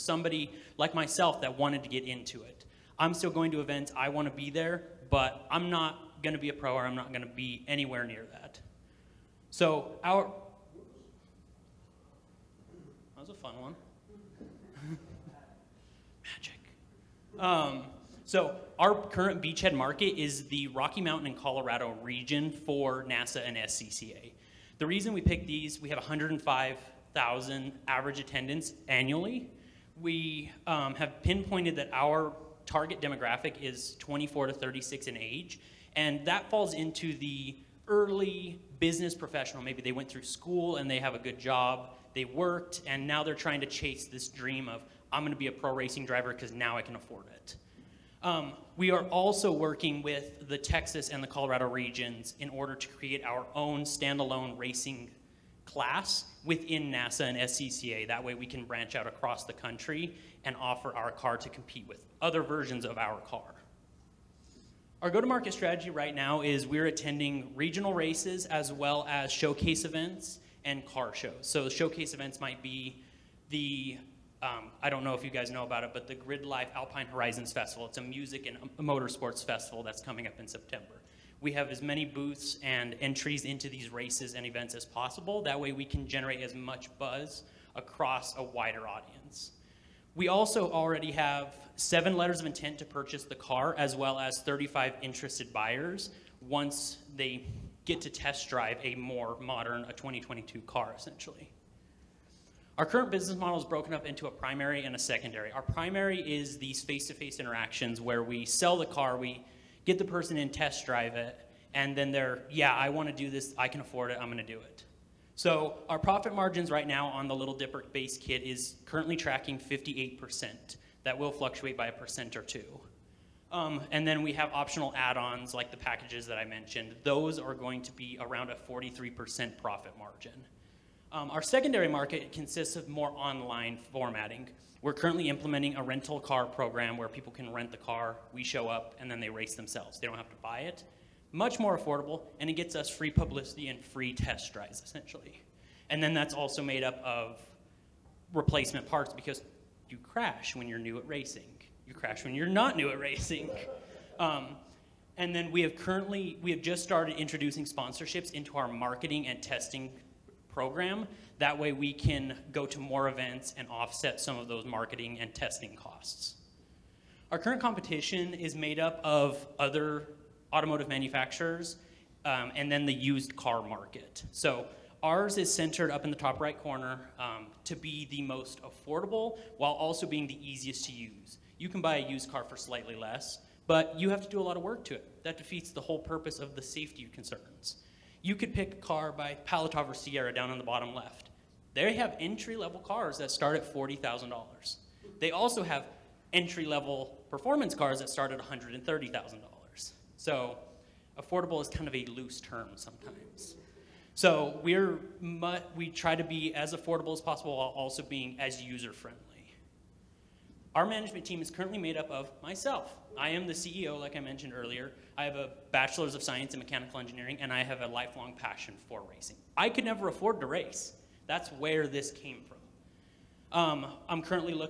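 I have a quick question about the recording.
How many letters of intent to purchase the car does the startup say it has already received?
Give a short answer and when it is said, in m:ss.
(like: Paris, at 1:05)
7, at 1:31.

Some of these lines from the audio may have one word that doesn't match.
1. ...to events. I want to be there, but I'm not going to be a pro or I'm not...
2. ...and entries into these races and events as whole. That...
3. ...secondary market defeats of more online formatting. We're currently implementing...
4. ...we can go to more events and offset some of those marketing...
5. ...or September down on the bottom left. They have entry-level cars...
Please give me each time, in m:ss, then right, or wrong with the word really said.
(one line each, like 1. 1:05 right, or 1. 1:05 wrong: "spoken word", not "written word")
1. 0:03 right
2. 1:22 wrong: "possible", not "whole"
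3. 2:11 wrong: "consists", not "defeats"
4. 2:41 right
5. 3:09 wrong: "Sierra", not "September".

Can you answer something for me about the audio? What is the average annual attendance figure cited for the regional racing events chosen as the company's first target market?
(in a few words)
105,000.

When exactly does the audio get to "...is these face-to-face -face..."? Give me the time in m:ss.
1:46.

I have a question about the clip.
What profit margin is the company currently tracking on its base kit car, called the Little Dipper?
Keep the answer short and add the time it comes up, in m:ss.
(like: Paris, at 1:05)
58%, at 1:59.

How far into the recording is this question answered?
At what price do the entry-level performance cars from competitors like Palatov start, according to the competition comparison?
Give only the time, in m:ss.
3:18.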